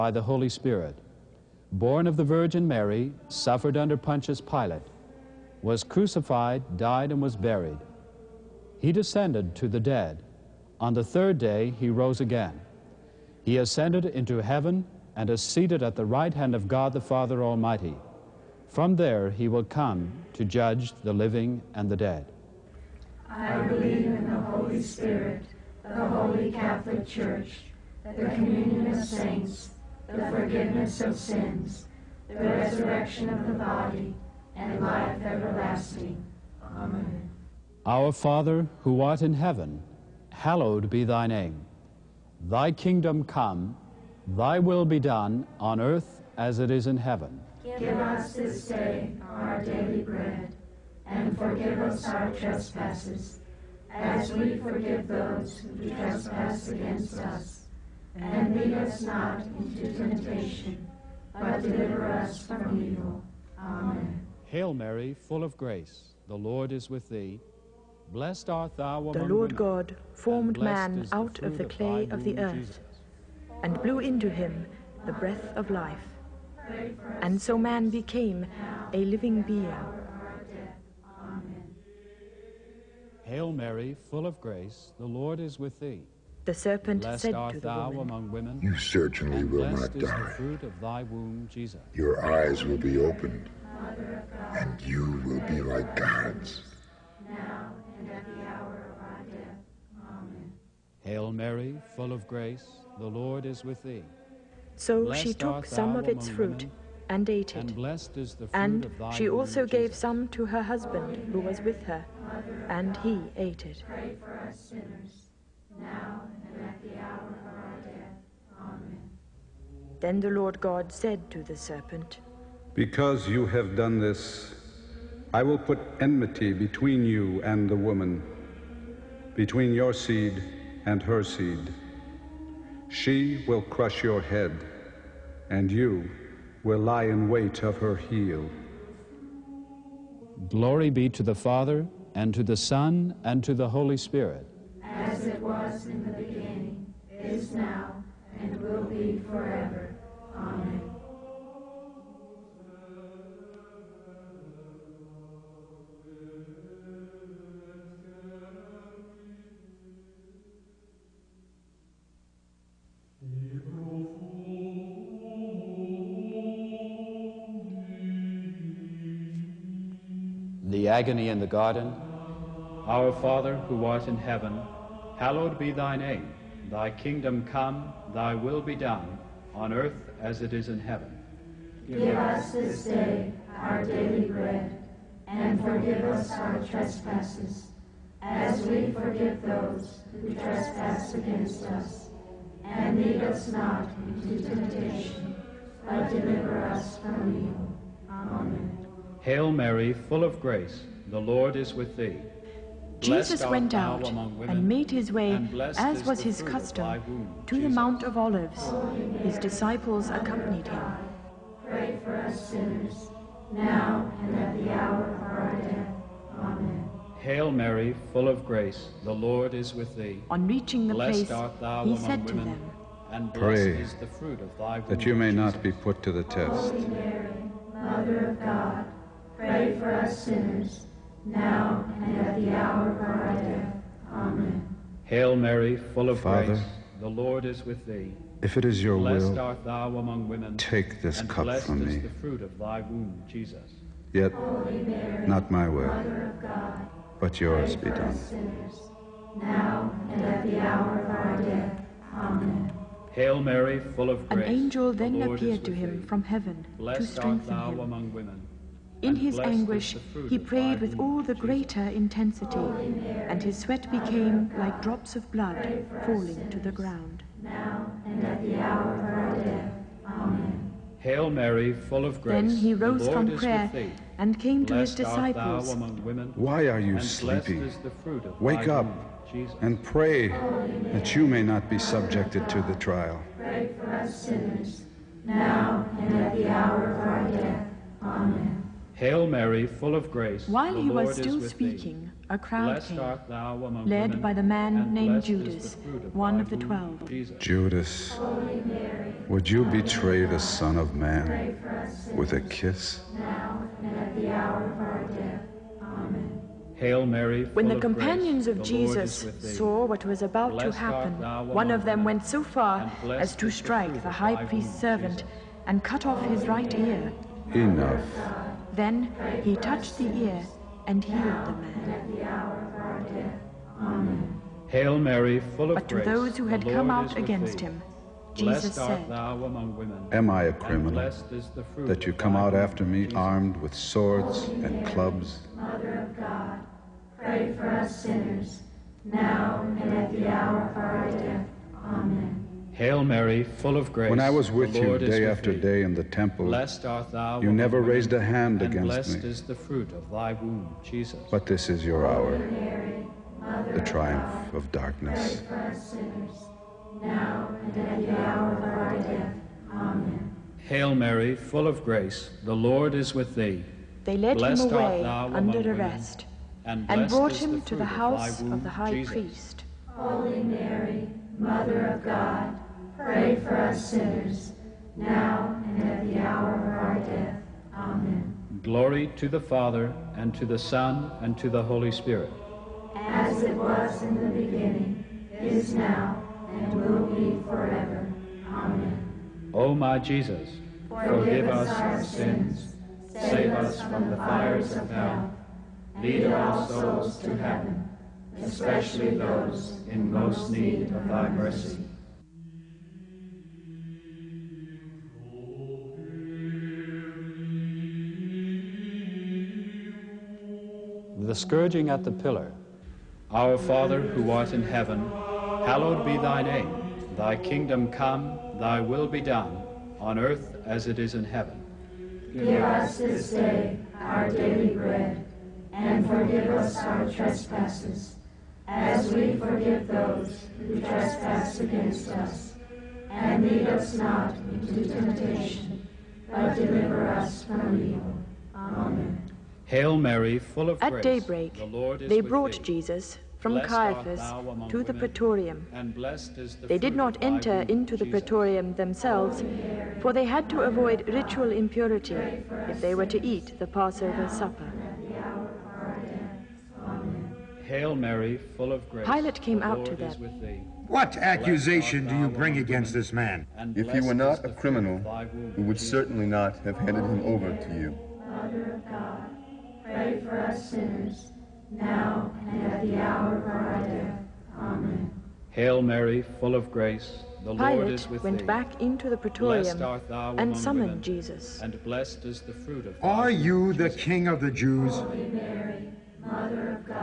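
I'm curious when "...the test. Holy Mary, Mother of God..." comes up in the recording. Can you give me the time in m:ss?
3:46.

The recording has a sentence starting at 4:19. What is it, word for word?
In his anguish, he prayed with all the greater intensity, and his sweat became like drops of blood falling to the ground.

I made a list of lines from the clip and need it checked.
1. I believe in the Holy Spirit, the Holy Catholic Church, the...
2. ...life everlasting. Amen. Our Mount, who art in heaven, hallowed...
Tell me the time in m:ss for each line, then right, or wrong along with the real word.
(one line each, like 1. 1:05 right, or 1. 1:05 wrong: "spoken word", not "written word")
1. 0:23 right
2. 0:34 wrong: "Father", not "Mount".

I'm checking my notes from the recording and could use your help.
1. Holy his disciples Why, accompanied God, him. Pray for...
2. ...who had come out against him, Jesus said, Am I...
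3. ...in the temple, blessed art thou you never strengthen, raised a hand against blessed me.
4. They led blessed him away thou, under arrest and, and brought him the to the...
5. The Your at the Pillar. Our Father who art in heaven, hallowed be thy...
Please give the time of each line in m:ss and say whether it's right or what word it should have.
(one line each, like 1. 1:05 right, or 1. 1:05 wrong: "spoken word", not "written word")
1. 3:28 wrong: "Mary", not "Why"
2. 5:26 right
3. 5:45 wrong: "women", not "strengthen"
4. 6:04 right
5. 6:51 wrong: "Scourging", not "Your".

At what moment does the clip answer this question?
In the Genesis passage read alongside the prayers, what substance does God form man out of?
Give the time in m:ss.
1:11.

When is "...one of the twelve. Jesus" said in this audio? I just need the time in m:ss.
4:56.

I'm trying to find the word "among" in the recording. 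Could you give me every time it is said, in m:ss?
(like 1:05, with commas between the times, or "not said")
1:09, 1:28, 3:59, 4:52.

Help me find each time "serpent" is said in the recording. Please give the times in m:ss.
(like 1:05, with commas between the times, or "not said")
1:26, 2:01.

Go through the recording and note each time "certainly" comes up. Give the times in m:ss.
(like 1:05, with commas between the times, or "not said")
1:28, 7:45.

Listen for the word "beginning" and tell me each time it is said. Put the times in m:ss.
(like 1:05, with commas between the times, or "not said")
2:26, 6:24.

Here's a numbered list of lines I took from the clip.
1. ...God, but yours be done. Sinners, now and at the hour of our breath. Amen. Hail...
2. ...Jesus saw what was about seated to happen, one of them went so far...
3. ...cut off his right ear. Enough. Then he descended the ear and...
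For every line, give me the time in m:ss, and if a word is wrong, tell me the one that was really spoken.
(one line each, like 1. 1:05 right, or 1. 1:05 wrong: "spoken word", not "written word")
1. 4:06 wrong: "death", not "breath"
2. 5:08 wrong: "blessed", not "seated"
3. 5:15 wrong: "touched", not "descended".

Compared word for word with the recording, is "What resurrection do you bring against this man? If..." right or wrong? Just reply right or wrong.
wrong.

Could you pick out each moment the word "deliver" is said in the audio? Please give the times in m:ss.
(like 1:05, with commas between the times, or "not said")
1:01, 3:16, 7:16.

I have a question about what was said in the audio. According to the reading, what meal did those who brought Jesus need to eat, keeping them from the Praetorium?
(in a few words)
Passover supper.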